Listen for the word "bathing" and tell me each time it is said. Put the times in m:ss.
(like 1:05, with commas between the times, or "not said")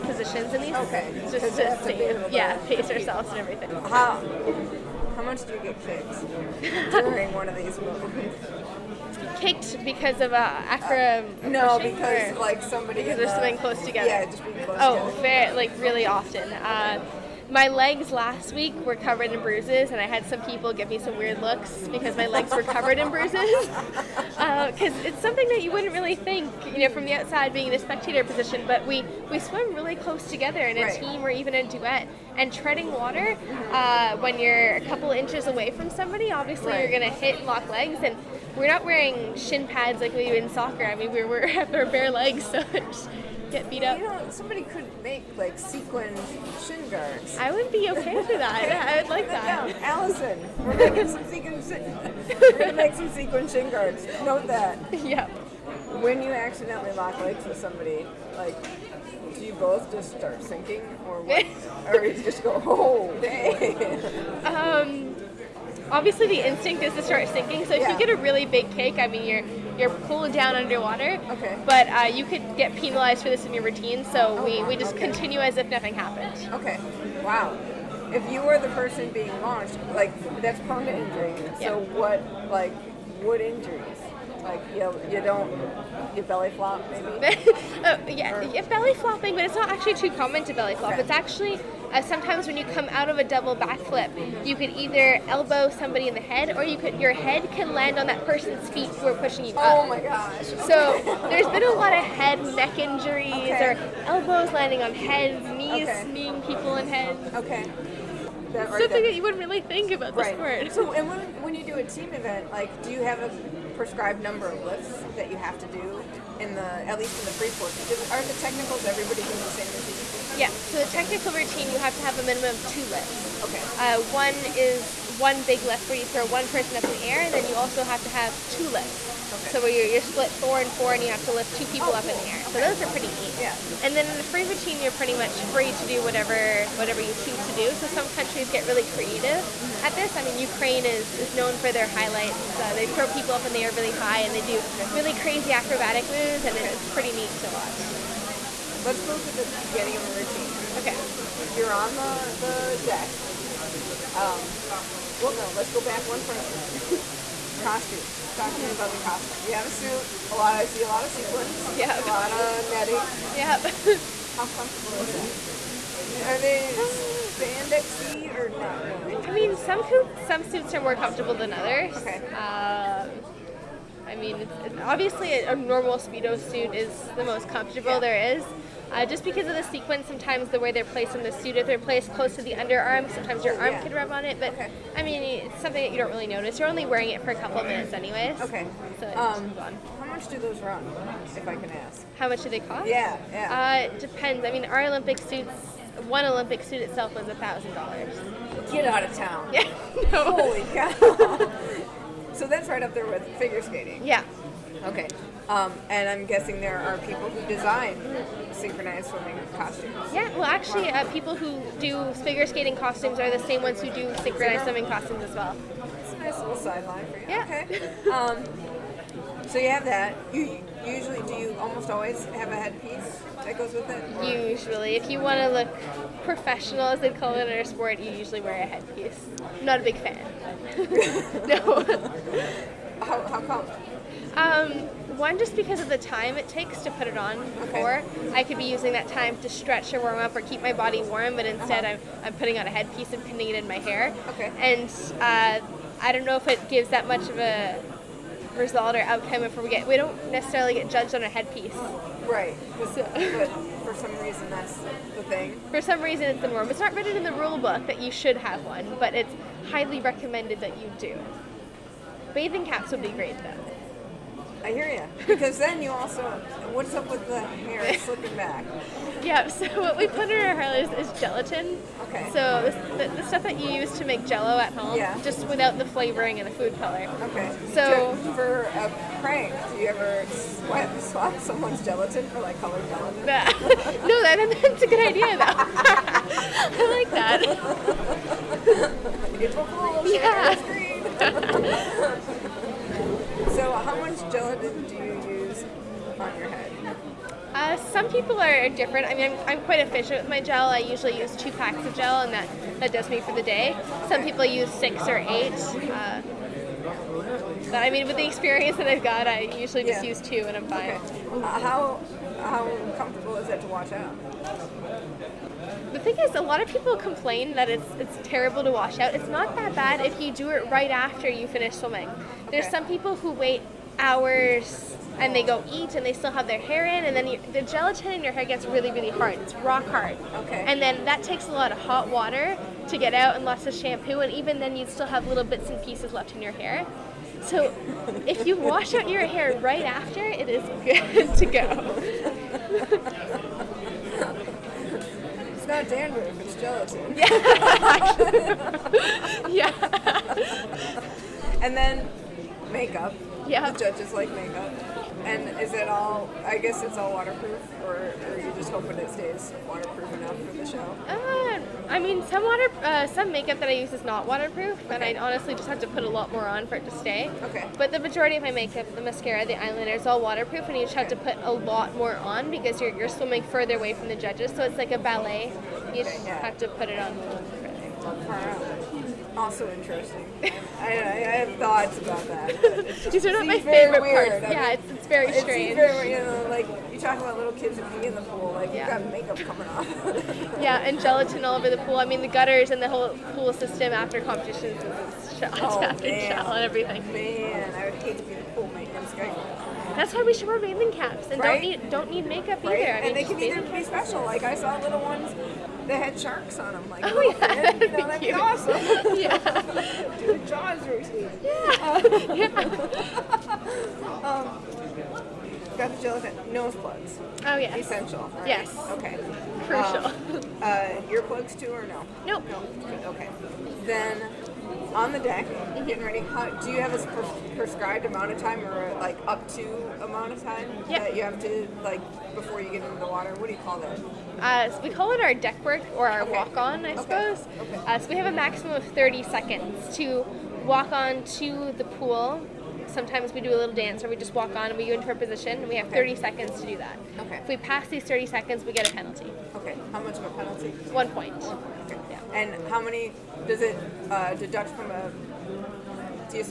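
4:22, 6:40.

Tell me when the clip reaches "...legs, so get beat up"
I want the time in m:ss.
0:42.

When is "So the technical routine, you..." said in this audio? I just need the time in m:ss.
2:00.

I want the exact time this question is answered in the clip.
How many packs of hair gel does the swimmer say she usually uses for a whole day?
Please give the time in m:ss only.
5:01.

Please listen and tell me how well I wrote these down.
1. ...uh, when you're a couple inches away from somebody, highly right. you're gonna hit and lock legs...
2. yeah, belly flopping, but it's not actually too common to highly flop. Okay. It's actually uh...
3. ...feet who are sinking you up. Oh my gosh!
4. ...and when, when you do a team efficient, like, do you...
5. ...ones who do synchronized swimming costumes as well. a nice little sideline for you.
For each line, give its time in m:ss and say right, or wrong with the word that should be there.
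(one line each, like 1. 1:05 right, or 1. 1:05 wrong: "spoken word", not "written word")
1. 0:33 wrong: "obviously", not "highly"
2. 1:28 wrong: "belly", not "highly"
3. 1:38 wrong: "pushing", not "sinking"
4. 1:50 wrong: "event", not "efficient"
5. 3:33 right.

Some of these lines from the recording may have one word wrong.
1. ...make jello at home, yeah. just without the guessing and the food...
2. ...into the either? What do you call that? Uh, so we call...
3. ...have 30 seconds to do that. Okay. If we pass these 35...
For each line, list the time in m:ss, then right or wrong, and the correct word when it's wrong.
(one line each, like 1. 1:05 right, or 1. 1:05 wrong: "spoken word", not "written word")
1. 4:34 wrong: "flavoring", not "guessing"
2. 7:12 wrong: "water", not "either"
3. 7:25 wrong: "30", not "35".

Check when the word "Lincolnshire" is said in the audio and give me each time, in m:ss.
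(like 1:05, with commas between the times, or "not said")
not said.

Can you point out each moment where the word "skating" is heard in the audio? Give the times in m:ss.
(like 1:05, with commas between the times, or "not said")
3:23, 3:32.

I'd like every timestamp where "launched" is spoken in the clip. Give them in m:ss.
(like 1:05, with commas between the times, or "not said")
1:19.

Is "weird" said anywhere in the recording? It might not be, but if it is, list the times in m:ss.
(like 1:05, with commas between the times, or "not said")
0:21, 6:24.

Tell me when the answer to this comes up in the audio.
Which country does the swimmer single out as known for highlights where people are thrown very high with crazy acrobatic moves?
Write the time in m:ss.
2:20.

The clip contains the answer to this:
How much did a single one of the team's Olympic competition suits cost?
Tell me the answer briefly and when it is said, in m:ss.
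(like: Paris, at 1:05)
$1,000, at 3:17.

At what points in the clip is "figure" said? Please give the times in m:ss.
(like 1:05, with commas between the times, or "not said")
3:23, 3:32.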